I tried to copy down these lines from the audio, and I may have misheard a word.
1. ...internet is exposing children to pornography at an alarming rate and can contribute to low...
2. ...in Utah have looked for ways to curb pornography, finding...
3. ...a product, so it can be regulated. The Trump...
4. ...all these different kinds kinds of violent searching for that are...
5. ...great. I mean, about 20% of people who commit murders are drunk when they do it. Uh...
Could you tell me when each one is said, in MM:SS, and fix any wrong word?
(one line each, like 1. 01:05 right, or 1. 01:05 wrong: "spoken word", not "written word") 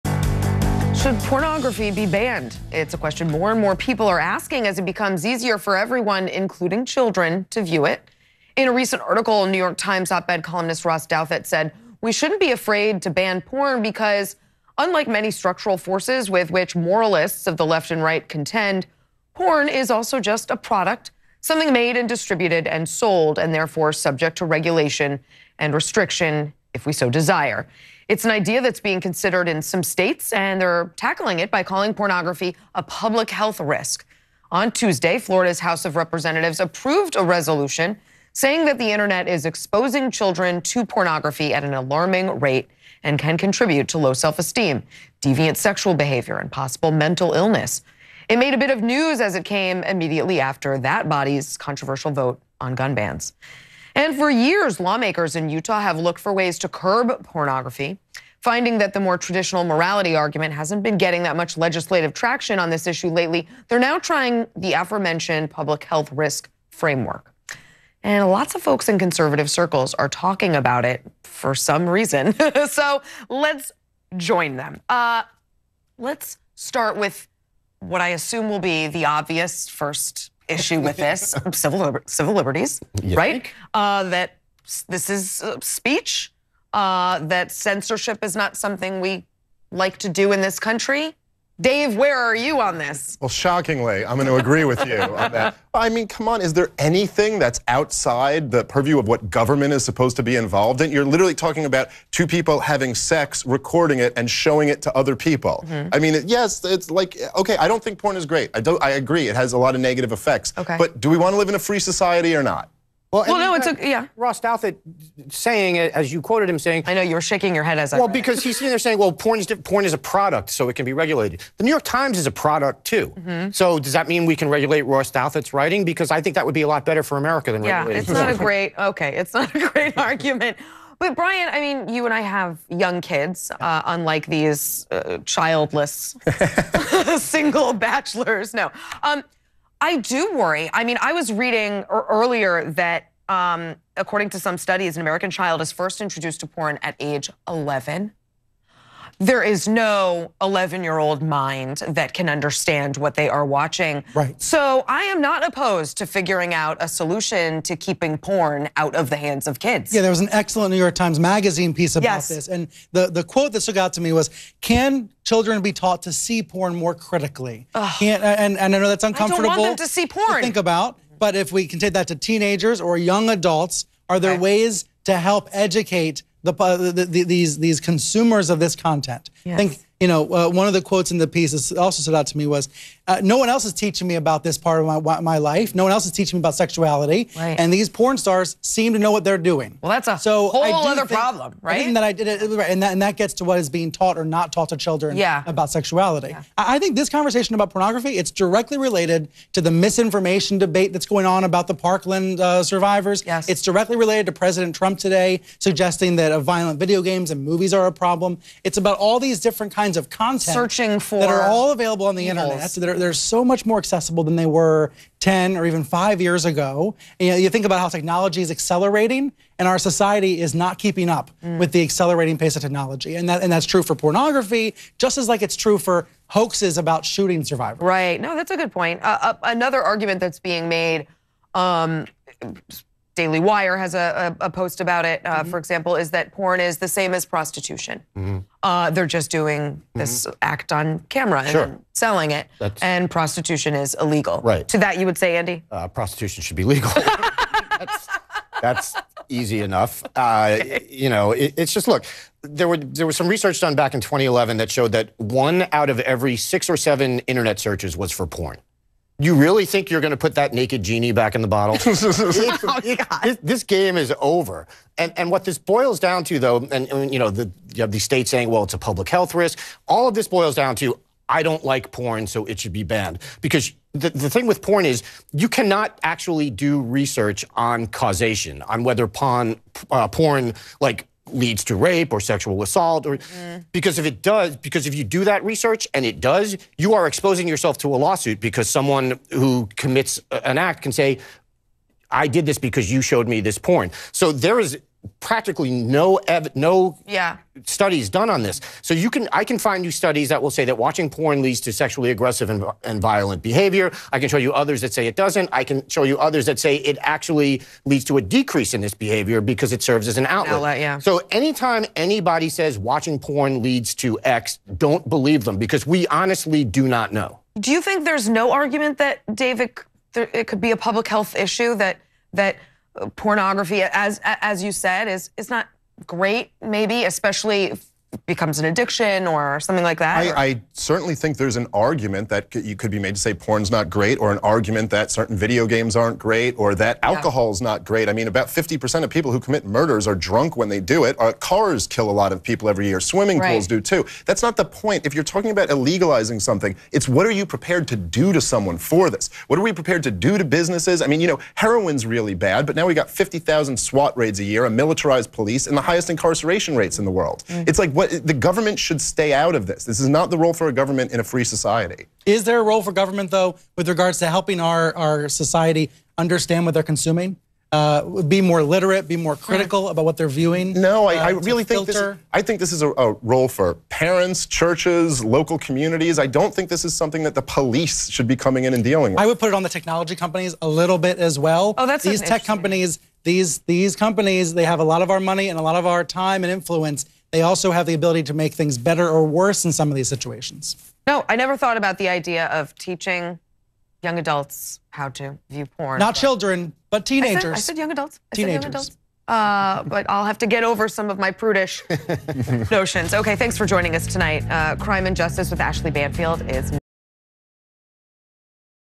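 1. 00:38 right
2. 00:55 right
3. 01:59 wrong: "New", not "Trump"
4. 03:28 wrong: "content", not "violent"
5. 05:37 wrong: "50", not "20".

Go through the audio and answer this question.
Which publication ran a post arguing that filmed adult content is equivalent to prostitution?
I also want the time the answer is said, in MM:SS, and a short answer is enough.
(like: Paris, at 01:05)
Daily Wire, at 03:53.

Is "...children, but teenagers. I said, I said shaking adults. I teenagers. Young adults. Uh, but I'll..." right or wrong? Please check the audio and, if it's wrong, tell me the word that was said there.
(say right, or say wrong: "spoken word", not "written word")
wrong: "young", not "shaking".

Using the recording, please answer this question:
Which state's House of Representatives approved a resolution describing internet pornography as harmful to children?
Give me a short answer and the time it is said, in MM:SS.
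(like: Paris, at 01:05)
Florida, at 00:35.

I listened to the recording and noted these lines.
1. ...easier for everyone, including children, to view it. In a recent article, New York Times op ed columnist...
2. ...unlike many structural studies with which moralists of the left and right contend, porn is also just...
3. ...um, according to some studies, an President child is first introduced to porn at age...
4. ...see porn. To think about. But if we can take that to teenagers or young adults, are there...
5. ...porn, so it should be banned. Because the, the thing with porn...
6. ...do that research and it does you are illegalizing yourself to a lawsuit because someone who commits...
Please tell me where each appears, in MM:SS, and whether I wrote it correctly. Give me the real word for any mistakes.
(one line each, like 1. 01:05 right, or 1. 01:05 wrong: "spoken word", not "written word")
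1. 00:05 right
2. 00:14 wrong: "forces", not "studies"
3. 02:23 wrong: "American", not "President"
4. 02:49 right
5. 04:31 right
6. 04:45 wrong: "exposing", not "illegalizing".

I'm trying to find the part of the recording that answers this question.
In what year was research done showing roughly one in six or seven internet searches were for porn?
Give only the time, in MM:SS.
04:14.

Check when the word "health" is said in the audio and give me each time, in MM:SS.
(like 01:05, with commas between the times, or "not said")
00:33, 01:05, 04:29, 05:21.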